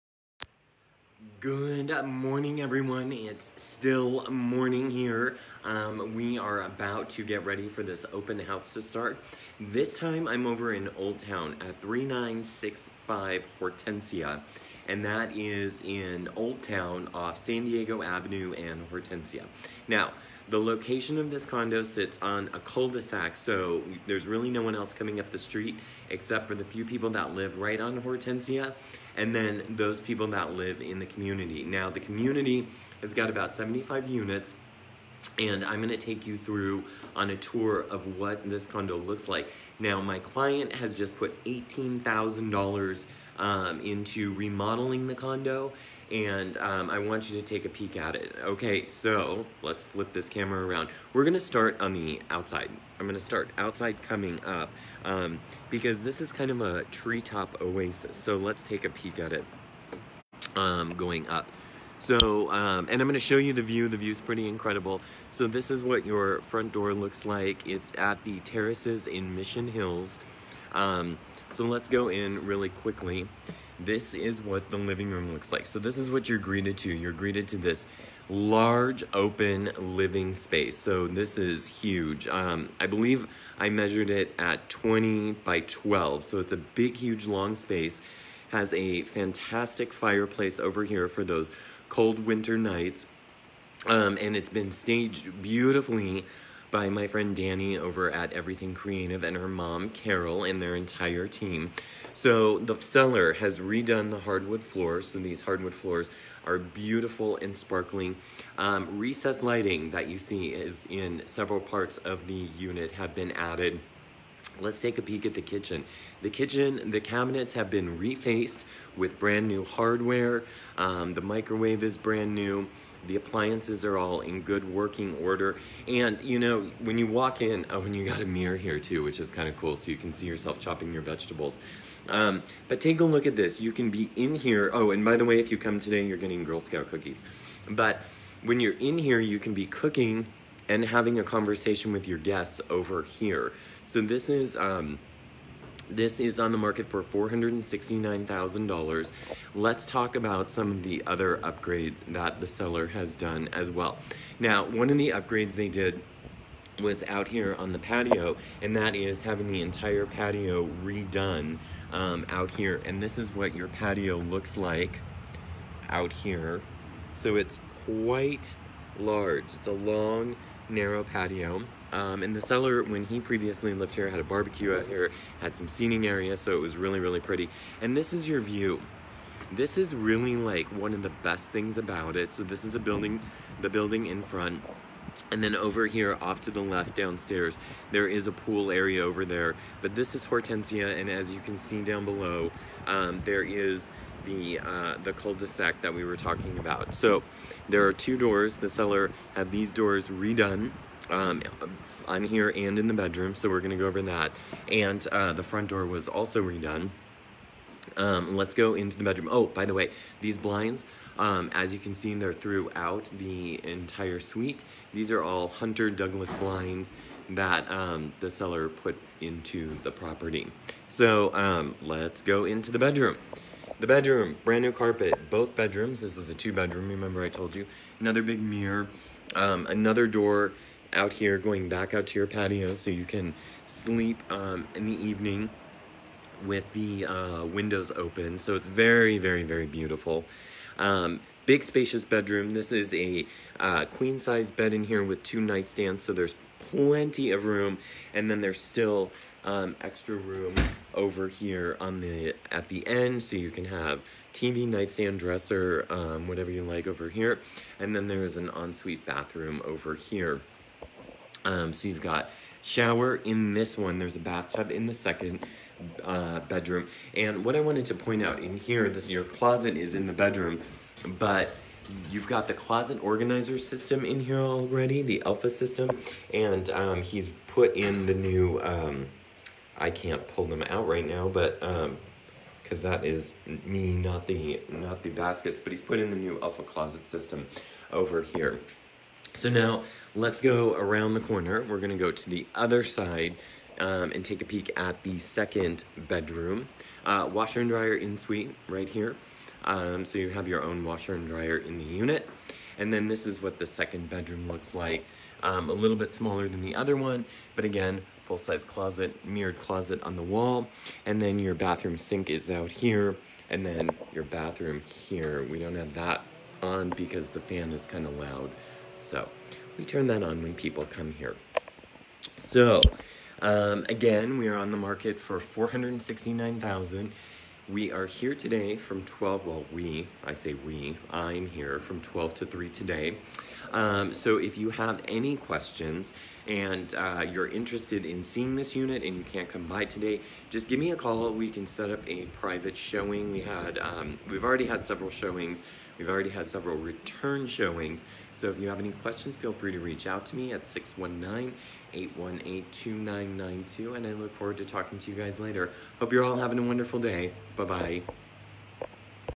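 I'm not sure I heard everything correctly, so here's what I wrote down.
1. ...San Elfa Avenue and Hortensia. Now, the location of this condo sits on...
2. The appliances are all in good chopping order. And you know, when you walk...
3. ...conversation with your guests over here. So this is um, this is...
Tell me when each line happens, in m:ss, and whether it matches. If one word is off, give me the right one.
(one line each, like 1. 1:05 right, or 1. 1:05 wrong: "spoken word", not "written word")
1. 0:17 wrong: "Diego", not "Elfa"
2. 2:03 wrong: "working", not "chopping"
3. 2:21 right.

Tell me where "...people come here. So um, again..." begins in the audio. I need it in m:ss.
5:20.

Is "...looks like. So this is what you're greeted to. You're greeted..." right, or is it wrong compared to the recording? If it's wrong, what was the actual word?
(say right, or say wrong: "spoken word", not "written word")
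right.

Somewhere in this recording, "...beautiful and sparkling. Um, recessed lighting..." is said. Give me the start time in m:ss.
1:46.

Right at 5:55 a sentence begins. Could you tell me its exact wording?
Hope you're all having a wonderful day.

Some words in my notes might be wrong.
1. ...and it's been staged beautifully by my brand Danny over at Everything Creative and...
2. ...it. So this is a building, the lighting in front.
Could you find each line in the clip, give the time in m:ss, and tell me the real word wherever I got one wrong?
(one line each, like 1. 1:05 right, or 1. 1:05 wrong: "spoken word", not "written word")
1. 1:34 wrong: "friend", not "brand"
2. 3:02 wrong: "building", not "lighting".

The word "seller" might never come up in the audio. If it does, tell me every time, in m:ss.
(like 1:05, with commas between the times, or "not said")
1:42, 2:32, 2:52, 3:18, 3:38.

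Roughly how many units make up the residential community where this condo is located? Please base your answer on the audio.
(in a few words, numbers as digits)
75.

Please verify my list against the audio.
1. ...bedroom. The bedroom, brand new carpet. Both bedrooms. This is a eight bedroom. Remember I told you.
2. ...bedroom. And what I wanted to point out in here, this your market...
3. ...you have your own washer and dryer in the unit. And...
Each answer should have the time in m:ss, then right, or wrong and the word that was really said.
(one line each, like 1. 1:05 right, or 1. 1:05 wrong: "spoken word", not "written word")
1. 3:42 wrong: "two", not "eight"
2. 4:26 wrong: "closet", not "market"
3. 5:00 right.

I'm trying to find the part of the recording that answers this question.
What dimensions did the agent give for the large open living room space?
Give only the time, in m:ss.
1:24.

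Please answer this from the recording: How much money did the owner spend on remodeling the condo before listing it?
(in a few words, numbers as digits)
$18,000.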